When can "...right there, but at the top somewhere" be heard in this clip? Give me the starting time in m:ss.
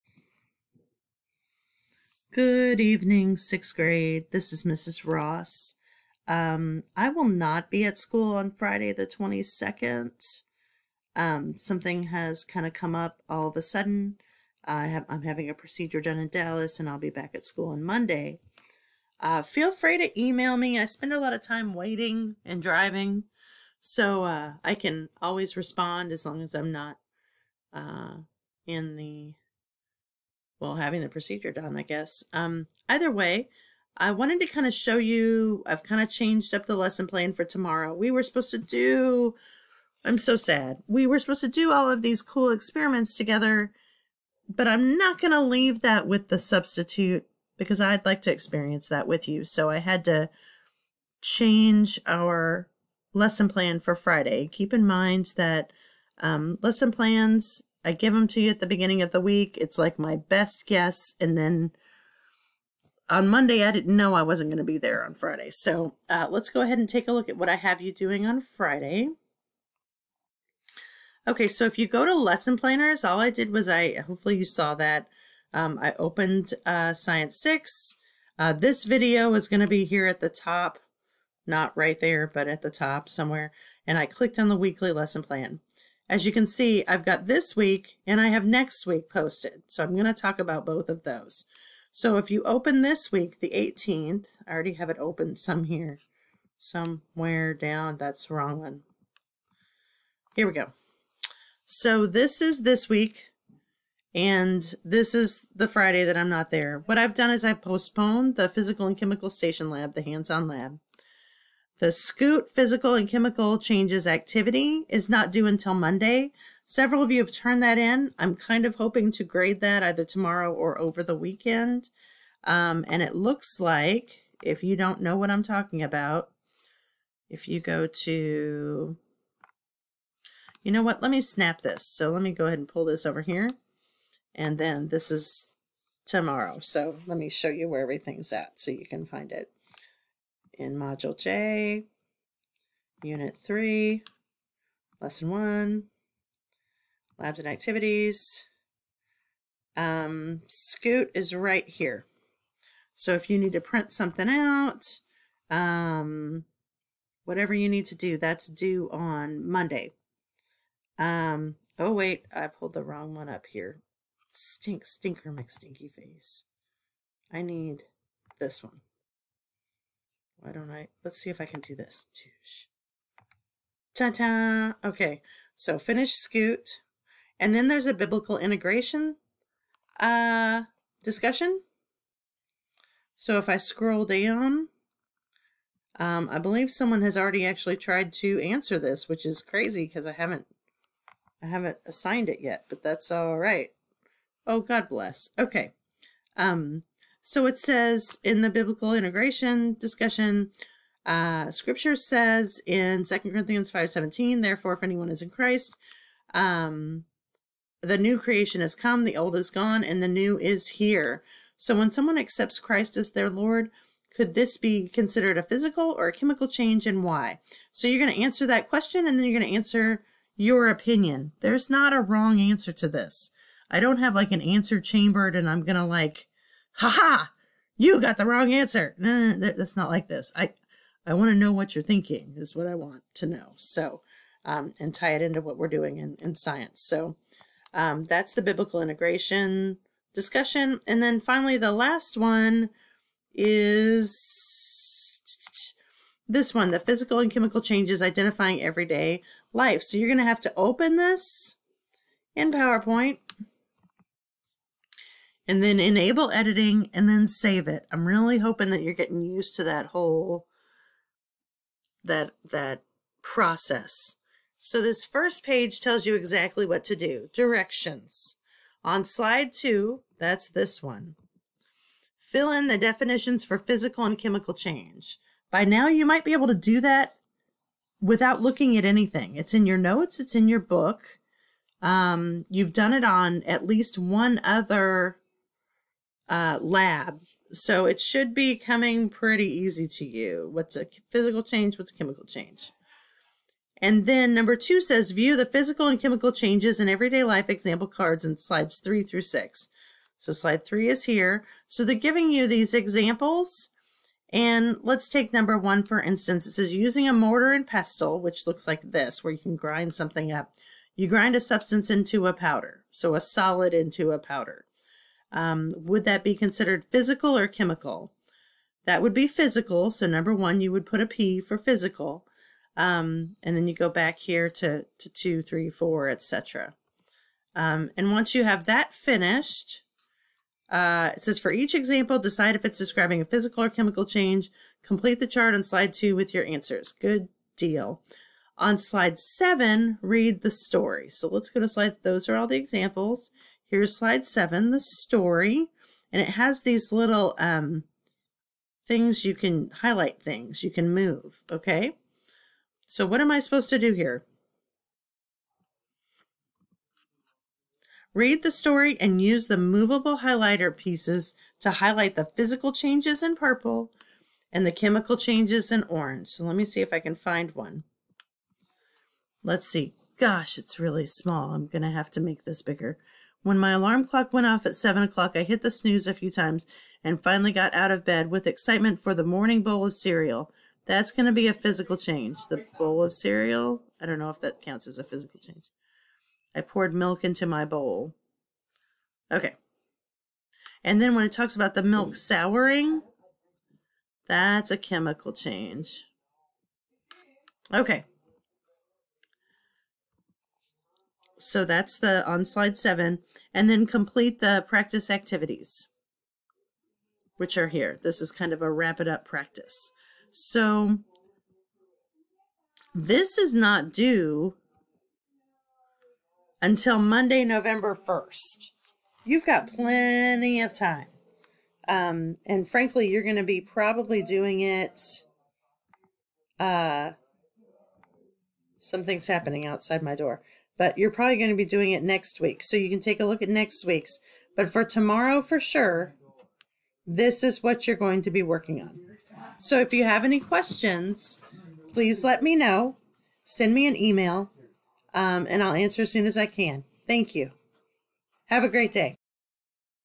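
1:21.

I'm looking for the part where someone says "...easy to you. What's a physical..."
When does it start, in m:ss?
4:49.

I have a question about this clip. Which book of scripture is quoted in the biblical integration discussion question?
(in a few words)
Second Corinthians.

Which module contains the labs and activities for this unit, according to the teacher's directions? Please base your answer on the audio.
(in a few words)
Module J.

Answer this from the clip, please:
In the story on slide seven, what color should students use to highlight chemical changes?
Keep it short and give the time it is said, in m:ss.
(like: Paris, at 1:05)
orange, at 6:05.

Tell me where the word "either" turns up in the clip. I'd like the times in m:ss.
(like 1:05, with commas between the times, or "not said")
0:32, 1:59.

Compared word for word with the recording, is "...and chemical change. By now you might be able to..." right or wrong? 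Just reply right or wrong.
right.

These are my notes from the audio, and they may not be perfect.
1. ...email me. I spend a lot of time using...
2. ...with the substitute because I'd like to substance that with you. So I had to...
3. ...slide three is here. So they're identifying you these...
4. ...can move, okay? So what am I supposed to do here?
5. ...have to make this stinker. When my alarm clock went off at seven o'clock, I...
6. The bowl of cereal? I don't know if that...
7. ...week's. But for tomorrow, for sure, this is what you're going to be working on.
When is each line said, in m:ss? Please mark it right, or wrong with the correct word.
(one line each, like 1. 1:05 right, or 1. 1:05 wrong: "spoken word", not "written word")
1. 0:20 wrong: "waiting", not "using"
2. 0:46 wrong: "experience", not "substance"
3. 5:00 wrong: "giving", not "identifying"
4. 5:50 right
5. 6:11 wrong: "bigger", not "stinker"
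6. 6:22 right
7. 7:13 right.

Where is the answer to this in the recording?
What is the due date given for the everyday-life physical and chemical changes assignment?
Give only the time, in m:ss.
6:56.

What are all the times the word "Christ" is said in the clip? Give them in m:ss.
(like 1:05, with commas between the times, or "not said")
3:25, 3:32.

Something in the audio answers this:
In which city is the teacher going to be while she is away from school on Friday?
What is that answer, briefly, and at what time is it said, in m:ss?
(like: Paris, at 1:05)
Dallas, at 0:16.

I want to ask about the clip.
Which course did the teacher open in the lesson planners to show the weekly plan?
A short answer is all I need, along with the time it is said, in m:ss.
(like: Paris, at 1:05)
Science 6, at 1:16.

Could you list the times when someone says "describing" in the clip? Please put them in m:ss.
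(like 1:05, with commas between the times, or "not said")
5:32.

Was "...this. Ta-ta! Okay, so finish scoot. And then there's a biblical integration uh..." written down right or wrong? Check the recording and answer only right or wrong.
right.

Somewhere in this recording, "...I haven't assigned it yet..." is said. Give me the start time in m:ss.
3:11.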